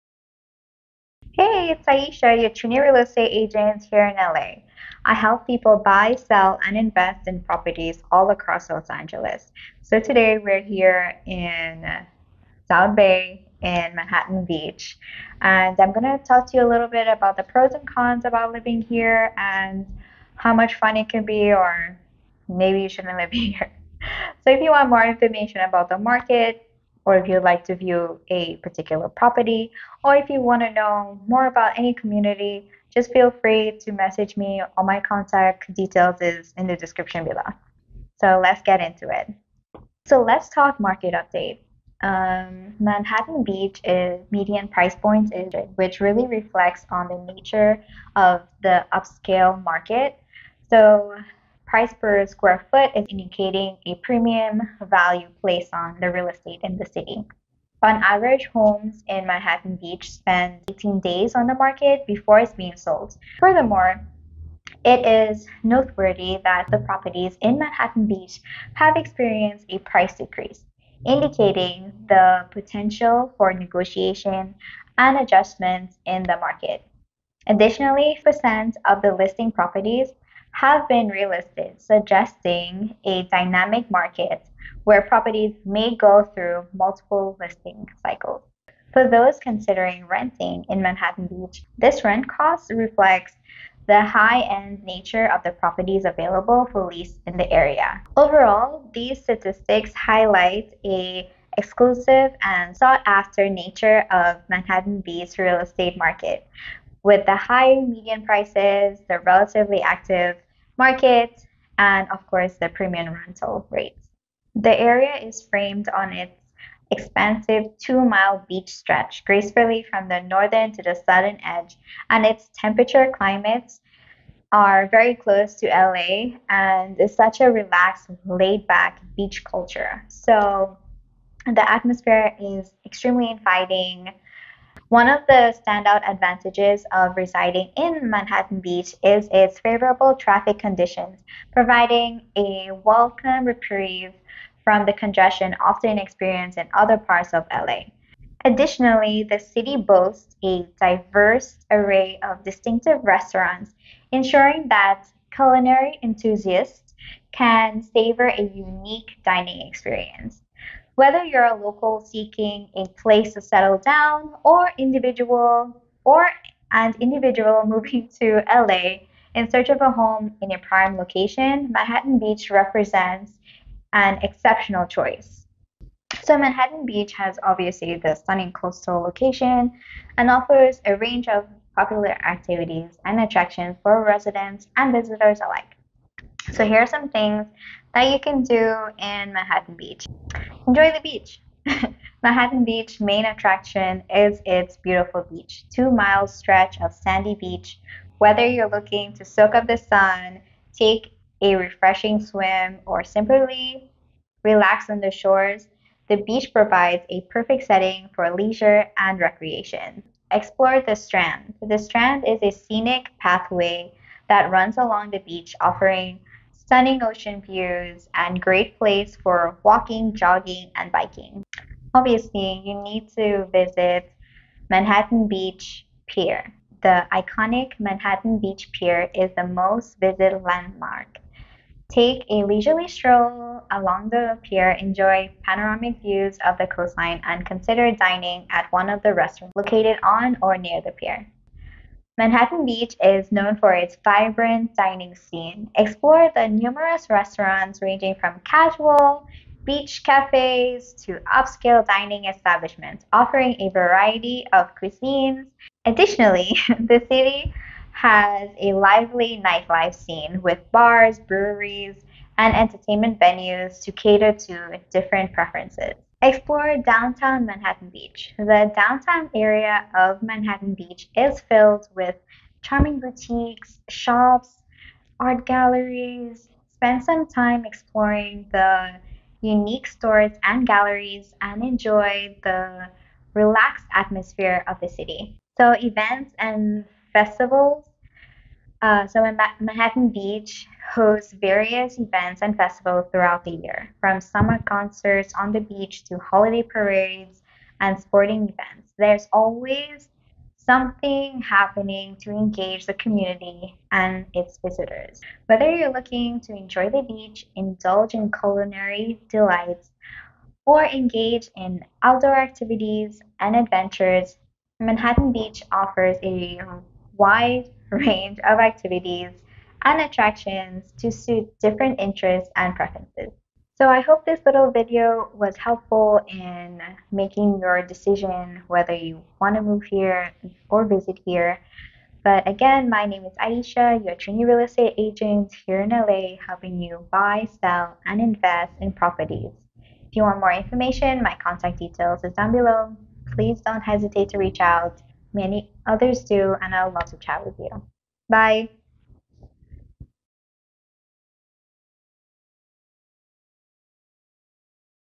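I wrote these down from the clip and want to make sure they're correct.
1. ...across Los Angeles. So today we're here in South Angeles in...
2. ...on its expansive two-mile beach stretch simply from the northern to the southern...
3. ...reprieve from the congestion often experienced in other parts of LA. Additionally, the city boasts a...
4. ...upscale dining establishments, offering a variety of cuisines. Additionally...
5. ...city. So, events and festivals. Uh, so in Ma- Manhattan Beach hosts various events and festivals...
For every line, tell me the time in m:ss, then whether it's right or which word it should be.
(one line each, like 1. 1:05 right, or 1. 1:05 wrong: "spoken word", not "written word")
1. 0:08 wrong: "Bay", not "Angeles"
2. 1:55 wrong: "gracefully", not "simply"
3. 2:23 right
4. 4:11 right
5. 4:44 right.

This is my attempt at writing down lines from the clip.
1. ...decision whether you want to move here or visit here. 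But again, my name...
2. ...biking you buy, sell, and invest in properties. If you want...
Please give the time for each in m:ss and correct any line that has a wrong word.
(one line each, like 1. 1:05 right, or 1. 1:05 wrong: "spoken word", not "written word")
1. 5:27 right
2. 5:36 wrong: "helping", not "biking".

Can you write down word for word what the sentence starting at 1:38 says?
Overall, these statistics highlight a exclusive and sought after nature of Manhattan Beach's real estate market.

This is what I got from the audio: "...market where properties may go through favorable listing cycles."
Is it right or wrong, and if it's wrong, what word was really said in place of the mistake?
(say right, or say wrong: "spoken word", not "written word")
wrong: "multiple", not "favorable".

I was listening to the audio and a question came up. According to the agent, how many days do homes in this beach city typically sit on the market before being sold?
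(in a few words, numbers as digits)
18 days.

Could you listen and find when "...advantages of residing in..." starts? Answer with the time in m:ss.
2:16.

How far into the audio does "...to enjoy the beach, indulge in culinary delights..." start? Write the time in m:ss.
5:06.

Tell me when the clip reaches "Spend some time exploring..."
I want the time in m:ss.
4:36.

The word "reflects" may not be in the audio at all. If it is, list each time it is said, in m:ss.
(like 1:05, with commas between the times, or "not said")
0:46, 1:32.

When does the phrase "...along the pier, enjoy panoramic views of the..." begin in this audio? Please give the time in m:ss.
3:53.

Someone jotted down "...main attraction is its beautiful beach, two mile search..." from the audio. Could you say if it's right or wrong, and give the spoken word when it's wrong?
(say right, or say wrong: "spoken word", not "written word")
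wrong: "stretch", not "search".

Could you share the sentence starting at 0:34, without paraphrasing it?
All my contact details is in the description below.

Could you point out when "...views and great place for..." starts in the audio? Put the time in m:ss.
3:37.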